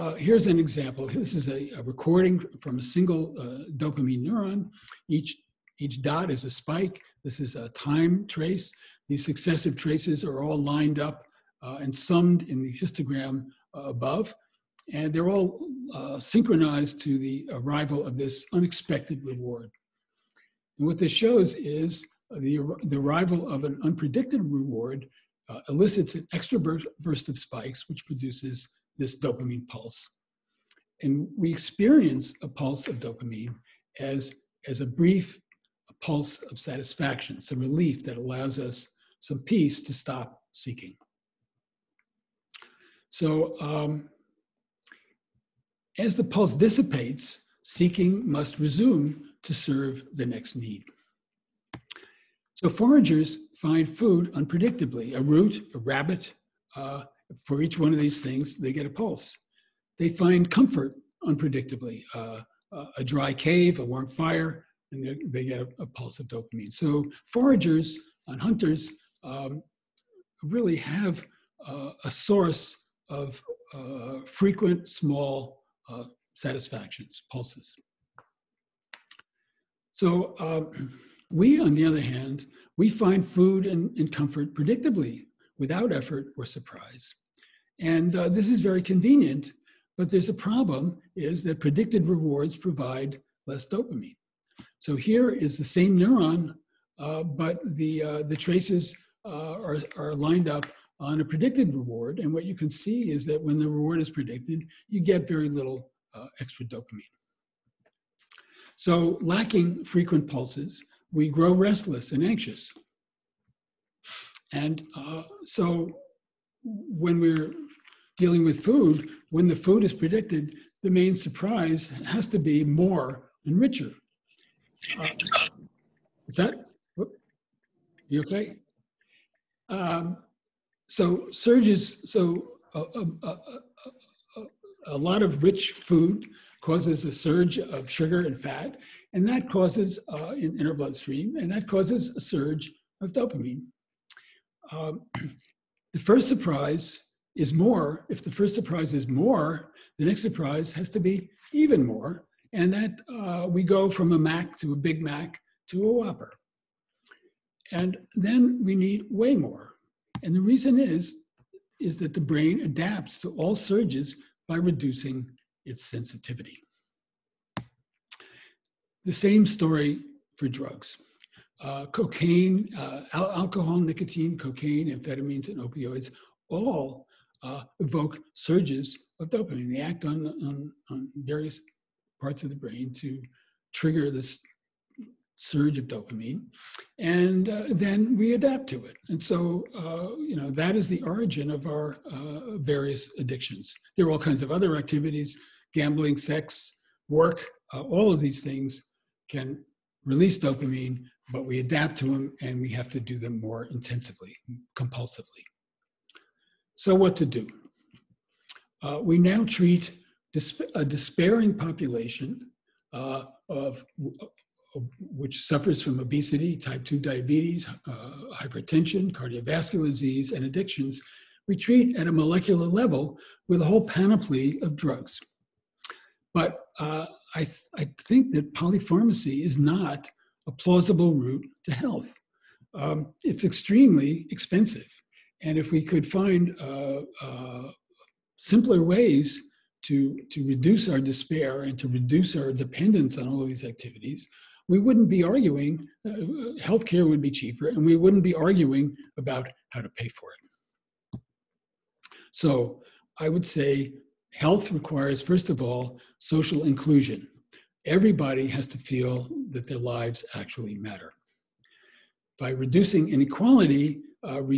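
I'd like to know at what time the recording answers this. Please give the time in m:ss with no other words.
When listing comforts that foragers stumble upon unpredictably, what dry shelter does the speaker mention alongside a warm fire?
1:02.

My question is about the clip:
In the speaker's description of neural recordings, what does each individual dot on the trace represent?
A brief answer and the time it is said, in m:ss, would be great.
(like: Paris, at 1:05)
A spike, at 0:05.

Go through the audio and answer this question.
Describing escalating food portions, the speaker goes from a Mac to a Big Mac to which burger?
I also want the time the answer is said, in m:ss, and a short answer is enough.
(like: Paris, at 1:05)
Whopper, at 2:35.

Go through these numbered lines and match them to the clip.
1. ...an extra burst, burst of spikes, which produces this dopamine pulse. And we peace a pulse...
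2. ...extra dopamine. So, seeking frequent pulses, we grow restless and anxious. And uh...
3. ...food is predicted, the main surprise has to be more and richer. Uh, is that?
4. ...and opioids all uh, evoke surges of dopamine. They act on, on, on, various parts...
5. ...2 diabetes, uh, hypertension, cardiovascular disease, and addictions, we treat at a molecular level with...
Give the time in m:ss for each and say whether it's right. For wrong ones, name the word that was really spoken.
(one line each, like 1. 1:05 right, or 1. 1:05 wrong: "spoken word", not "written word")
1. 0:26 wrong: "experience", not "peace"
2. 1:46 wrong: "lacking", not "seeking"
3. 1:59 right
4. 2:55 right
5. 3:36 right.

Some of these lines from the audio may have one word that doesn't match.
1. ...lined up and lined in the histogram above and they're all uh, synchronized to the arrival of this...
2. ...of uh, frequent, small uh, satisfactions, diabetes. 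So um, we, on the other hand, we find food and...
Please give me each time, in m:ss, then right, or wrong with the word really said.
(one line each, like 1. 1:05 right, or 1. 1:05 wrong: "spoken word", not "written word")
1. 0:10 wrong: "summed", not "lined"
2. 1:13 wrong: "pulses", not "diabetes".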